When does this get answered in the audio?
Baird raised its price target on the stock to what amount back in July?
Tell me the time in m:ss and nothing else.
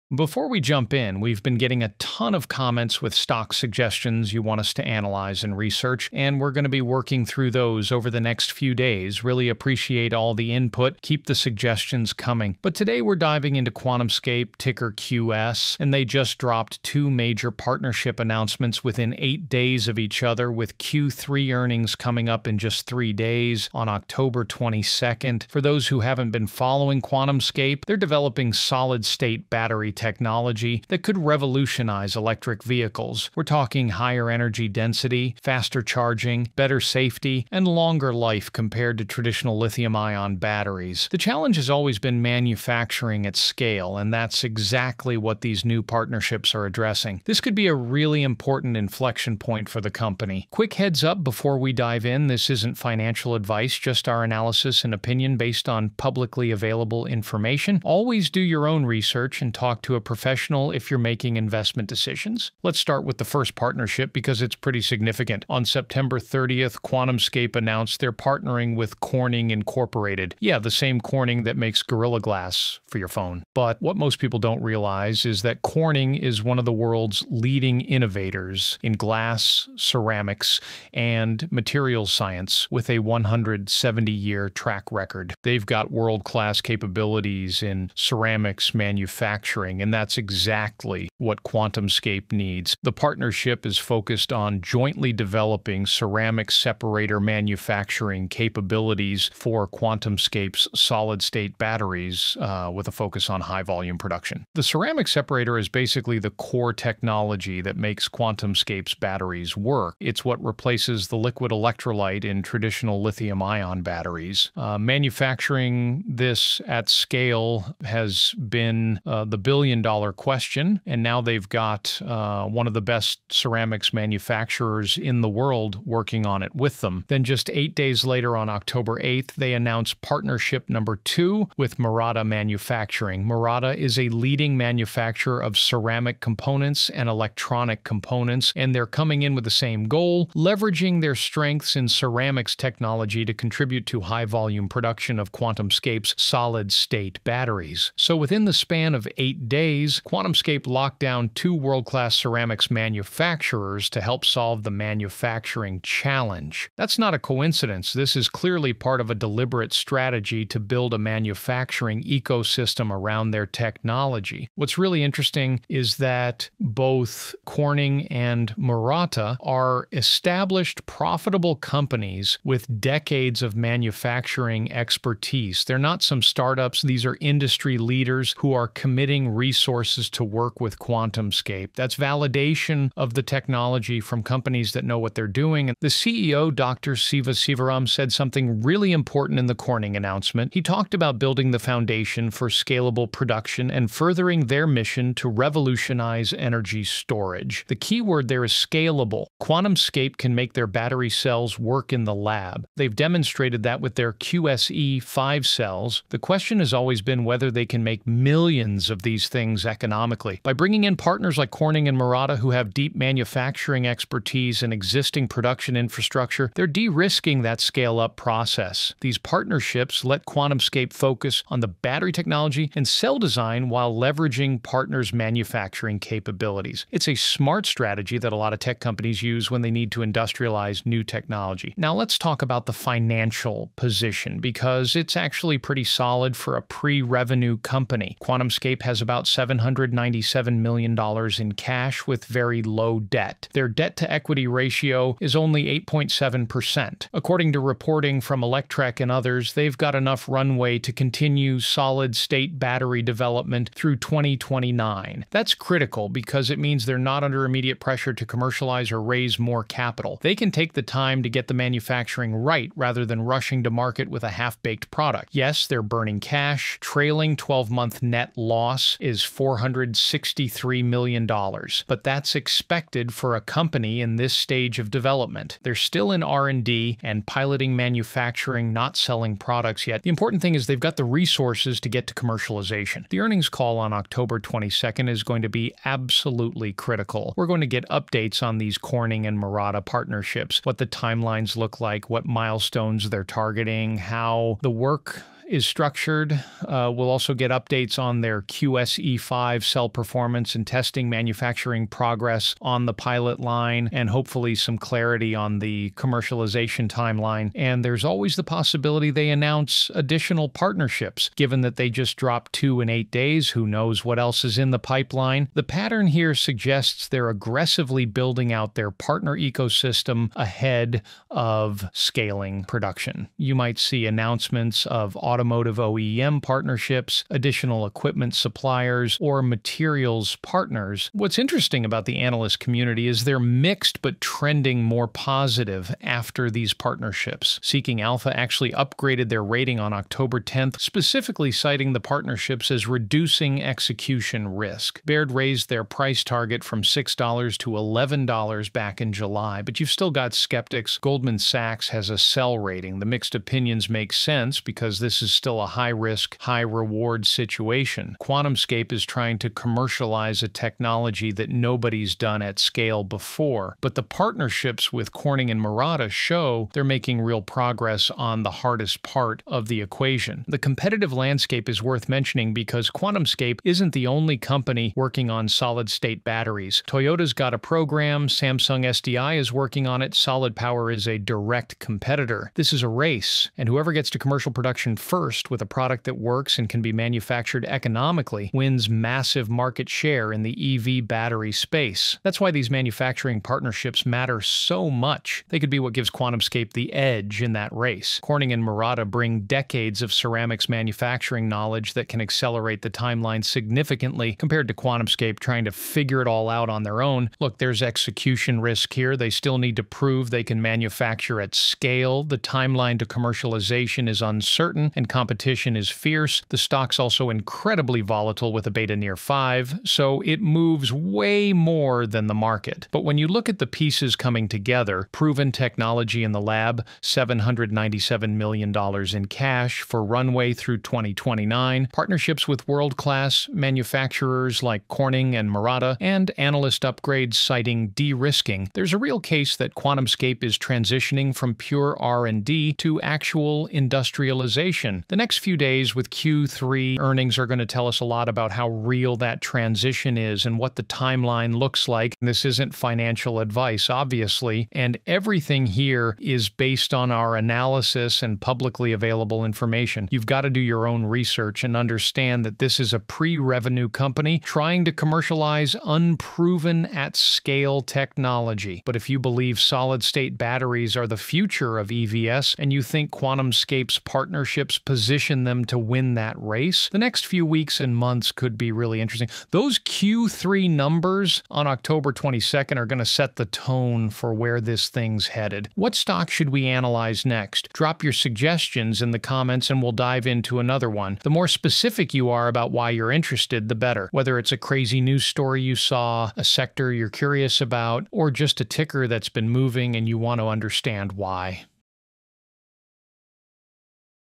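5:47.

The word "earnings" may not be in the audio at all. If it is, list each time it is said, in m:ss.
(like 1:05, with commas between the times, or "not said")
0:21, 4:43, 7:26.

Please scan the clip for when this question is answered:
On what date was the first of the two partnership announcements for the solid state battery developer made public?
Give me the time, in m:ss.
1:05.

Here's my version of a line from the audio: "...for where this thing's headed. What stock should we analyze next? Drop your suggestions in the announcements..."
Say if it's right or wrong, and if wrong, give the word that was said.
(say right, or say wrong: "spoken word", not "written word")
wrong: "comments", not "announcements".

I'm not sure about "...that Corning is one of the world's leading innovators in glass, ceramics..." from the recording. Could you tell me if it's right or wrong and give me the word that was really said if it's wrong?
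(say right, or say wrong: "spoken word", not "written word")
right.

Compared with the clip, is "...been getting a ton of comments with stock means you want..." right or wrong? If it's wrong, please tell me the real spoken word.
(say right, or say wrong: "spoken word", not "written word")
wrong: "suggestions", not "means".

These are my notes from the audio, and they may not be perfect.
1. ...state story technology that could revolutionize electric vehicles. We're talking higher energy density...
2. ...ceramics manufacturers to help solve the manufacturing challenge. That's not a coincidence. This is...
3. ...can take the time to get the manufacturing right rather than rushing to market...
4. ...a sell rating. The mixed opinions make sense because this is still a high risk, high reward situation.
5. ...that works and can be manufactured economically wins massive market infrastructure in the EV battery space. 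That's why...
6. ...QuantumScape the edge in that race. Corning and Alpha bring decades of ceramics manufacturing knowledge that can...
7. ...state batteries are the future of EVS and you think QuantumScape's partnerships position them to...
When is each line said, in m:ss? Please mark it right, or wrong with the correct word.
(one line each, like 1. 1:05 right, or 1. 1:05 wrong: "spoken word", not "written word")
1. 0:29 wrong: "battery", not "story"
2. 2:32 right
3. 4:20 right
4. 5:52 right
5. 6:26 wrong: "share", not "infrastructure"
6. 6:36 wrong: "Murata", not "Alpha"
7. 7:50 right.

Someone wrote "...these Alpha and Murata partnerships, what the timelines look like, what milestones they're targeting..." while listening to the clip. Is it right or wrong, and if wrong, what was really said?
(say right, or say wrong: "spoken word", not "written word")
wrong: "Corning", not "Alpha".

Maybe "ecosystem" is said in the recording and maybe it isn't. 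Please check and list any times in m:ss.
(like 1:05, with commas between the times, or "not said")
2:42, 5:19.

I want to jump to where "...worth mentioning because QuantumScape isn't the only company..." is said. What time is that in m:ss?
6:11.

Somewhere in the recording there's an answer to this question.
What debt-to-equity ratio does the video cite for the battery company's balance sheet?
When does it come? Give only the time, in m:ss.
4:05.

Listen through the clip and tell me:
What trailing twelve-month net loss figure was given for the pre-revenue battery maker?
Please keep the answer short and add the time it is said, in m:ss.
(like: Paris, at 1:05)
$463 million, at 4:29.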